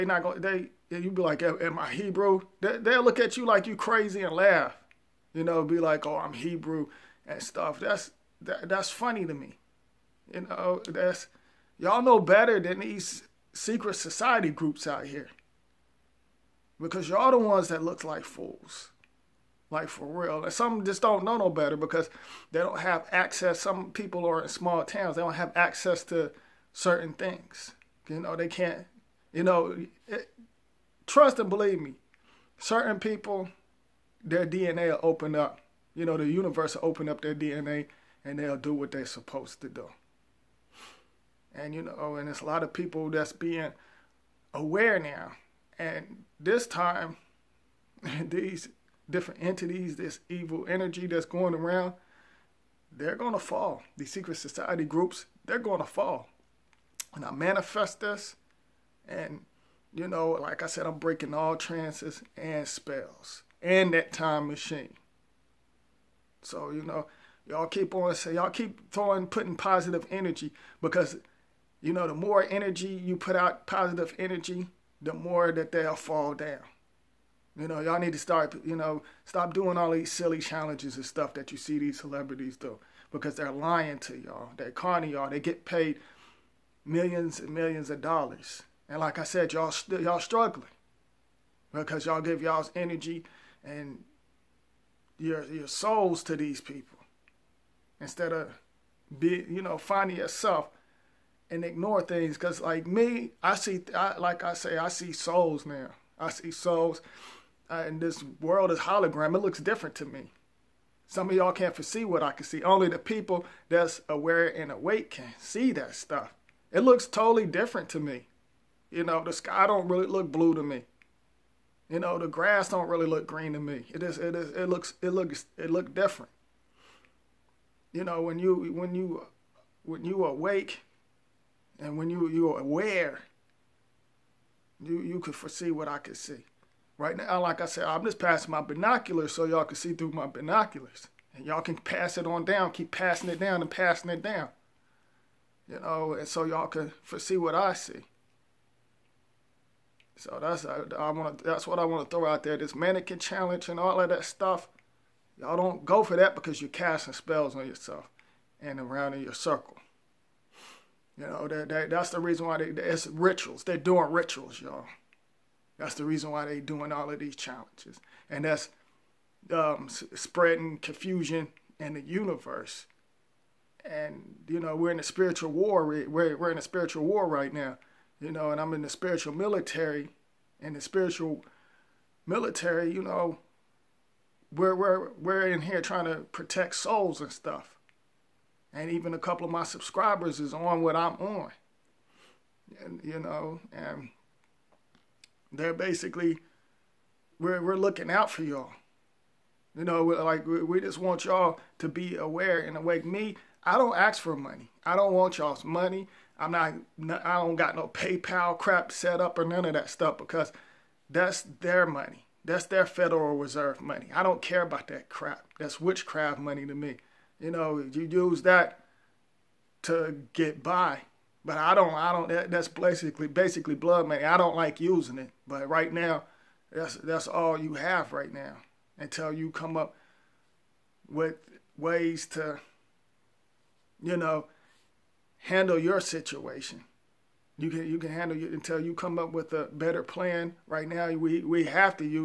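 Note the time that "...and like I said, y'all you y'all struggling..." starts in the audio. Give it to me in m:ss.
1:28.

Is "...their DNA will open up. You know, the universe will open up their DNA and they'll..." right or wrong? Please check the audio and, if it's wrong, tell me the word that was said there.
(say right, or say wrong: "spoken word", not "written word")
right.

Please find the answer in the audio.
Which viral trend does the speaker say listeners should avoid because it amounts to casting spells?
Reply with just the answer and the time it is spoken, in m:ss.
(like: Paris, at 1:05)
Mannequin challenge, at 2:32.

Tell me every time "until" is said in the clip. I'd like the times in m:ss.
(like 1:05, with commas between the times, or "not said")
3:48, 3:58.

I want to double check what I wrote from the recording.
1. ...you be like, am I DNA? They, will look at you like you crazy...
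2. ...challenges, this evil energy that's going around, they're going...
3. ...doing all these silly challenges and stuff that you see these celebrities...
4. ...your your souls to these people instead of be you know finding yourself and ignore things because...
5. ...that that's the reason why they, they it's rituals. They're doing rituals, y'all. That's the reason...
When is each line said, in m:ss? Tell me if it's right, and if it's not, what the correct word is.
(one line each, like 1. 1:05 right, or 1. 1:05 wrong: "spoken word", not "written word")
1. 0:01 wrong: "Hebrew", not "DNA"
2. 0:49 wrong: "entities", not "challenges"
3. 1:19 right
4. 1:35 right
5. 2:41 right.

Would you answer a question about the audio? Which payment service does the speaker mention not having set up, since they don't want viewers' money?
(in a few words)
PayPal.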